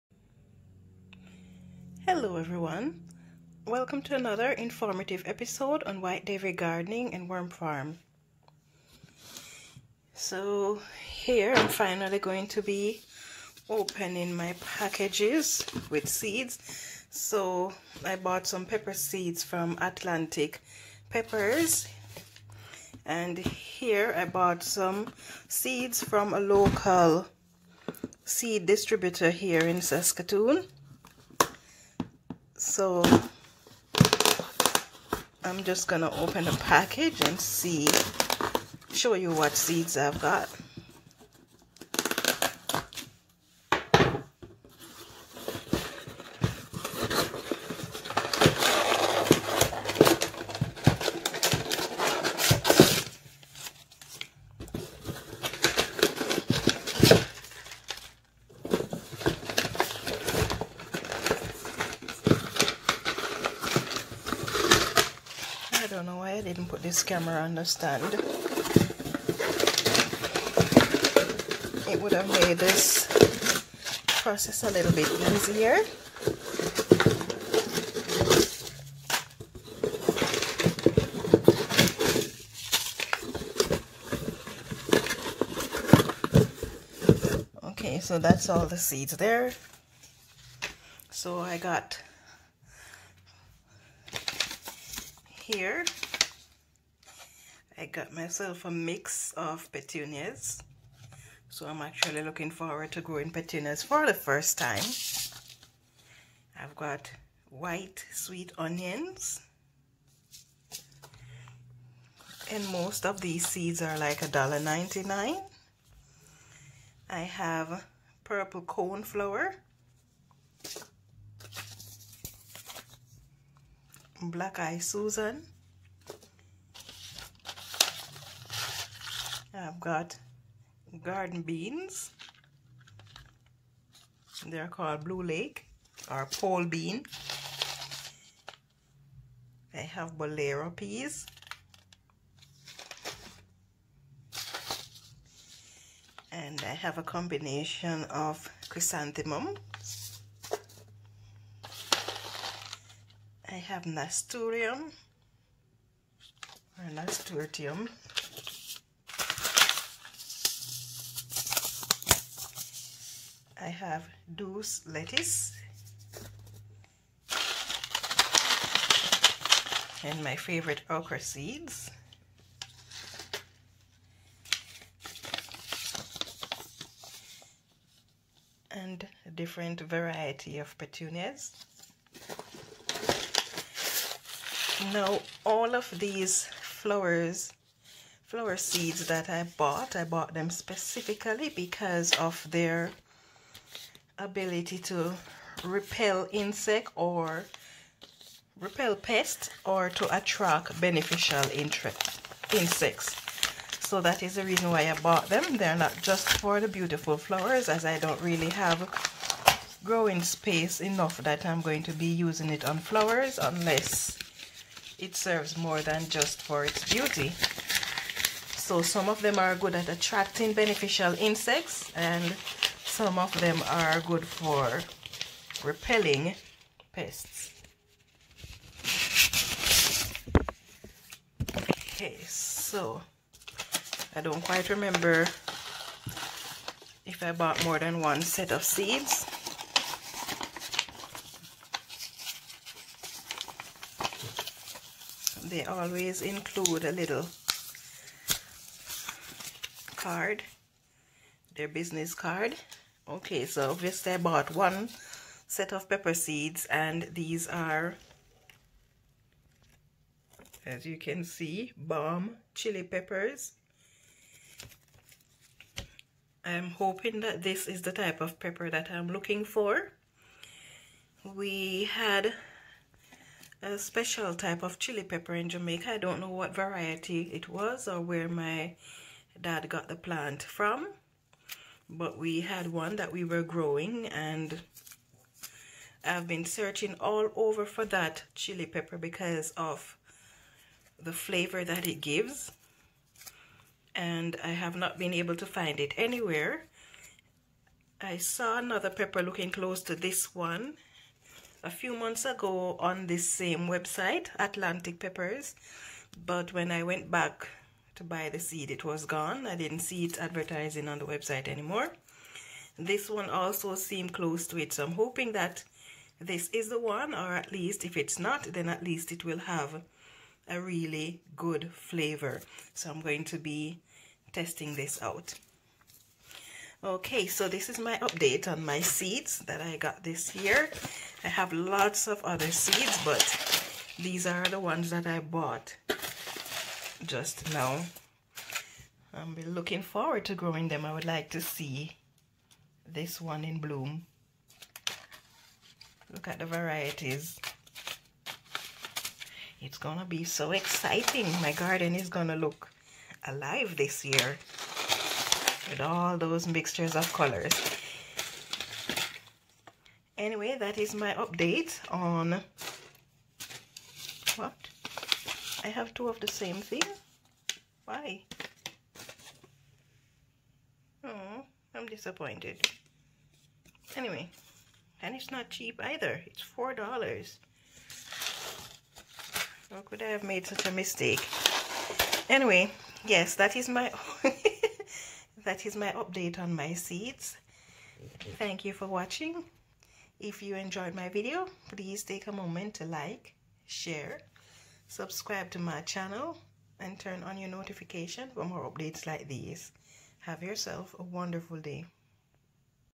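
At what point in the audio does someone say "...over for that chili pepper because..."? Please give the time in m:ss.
4:47.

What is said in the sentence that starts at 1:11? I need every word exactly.
It would have made this process a little bit easier.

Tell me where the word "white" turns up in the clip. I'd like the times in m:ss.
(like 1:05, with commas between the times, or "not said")
1:47.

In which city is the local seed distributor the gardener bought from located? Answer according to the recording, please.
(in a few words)
Saskatoon.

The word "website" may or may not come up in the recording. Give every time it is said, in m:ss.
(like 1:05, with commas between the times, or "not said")
5:03, 5:11.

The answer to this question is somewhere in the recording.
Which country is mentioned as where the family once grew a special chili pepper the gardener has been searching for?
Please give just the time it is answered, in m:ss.
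4:35.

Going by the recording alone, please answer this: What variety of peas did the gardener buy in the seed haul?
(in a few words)
Bolero.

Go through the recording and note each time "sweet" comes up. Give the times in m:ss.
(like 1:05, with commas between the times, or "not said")
1:48.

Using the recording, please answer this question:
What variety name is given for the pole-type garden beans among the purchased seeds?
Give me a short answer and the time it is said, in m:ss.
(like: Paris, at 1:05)
Blue Lake, at 2:15.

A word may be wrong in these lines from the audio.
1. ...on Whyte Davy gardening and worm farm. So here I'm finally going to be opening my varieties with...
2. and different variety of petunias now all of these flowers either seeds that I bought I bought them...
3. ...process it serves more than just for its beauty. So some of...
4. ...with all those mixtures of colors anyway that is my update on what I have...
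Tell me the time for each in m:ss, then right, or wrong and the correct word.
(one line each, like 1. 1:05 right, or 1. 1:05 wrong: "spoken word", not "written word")
1. 0:05 wrong: "packages", not "varieties"
2. 2:58 wrong: "flower", not "either"
3. 3:33 wrong: "unless", not "process"
4. 5:55 right.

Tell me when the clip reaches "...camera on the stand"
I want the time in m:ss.
1:07.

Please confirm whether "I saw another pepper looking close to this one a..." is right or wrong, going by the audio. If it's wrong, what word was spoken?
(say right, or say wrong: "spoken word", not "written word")
right.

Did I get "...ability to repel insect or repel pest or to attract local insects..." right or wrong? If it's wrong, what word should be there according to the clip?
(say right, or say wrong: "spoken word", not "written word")
wrong: "beneficial", not "local".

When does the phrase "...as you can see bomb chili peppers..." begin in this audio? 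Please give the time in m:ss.
4:20.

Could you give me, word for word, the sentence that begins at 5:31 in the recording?
I have lots of other seeds, but these are the ones that I bought just now.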